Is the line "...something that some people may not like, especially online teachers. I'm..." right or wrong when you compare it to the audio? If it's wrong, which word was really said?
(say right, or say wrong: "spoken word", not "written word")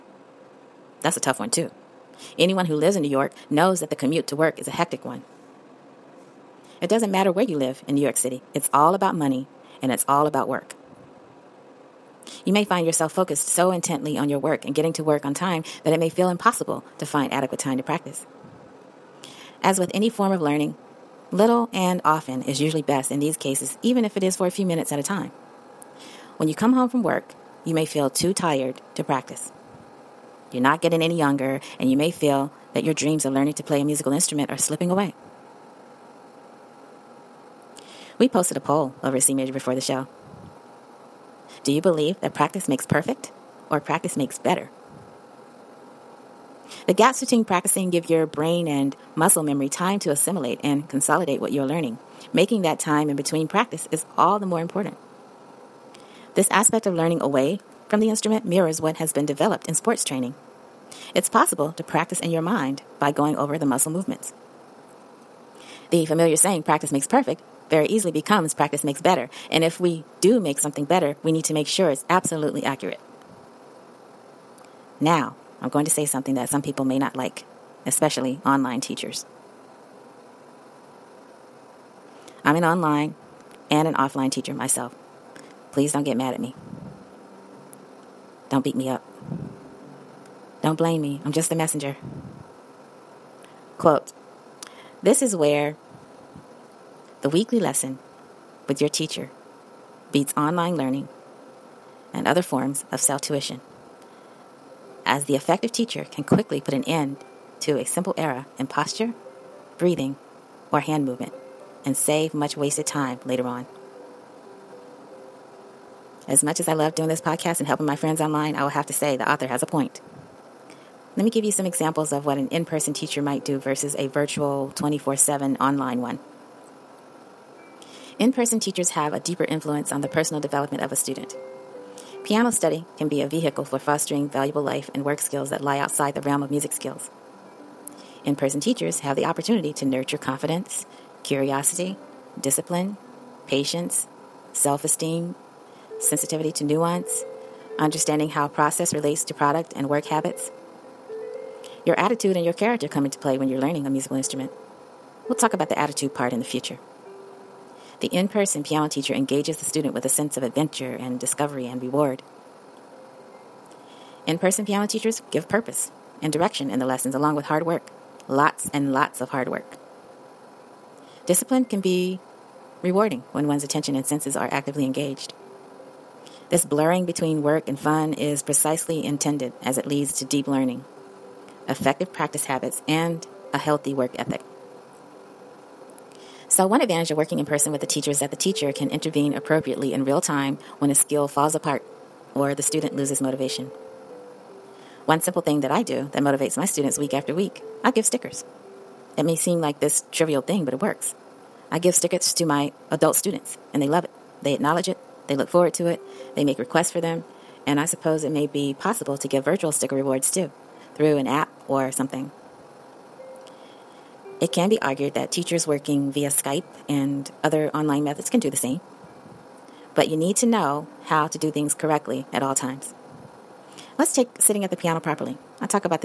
right.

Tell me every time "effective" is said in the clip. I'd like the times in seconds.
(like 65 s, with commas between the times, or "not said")
105 s, 181 s.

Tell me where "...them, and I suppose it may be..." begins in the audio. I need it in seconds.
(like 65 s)
206 s.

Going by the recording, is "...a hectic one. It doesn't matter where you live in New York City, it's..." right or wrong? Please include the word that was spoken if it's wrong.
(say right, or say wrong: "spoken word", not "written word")
right.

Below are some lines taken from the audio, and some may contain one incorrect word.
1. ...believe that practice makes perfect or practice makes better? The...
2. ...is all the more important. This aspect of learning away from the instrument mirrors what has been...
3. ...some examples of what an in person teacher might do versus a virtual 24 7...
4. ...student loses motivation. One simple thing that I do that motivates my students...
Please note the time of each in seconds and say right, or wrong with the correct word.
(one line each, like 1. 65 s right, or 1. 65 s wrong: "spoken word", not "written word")
1. 41 s right
2. 53 s right
3. 121 s right
4. 192 s right.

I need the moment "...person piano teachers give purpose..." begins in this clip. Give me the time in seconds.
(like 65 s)
164 s.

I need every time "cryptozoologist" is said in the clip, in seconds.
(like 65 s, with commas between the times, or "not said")
not said.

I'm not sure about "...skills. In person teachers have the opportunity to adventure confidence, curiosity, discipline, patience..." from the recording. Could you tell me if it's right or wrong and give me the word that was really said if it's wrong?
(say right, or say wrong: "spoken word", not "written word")
wrong: "nurture", not "adventure".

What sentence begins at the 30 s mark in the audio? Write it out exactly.
You're not getting any younger, and you may feel that your dreams of learning to play a musical instrument are slipping away.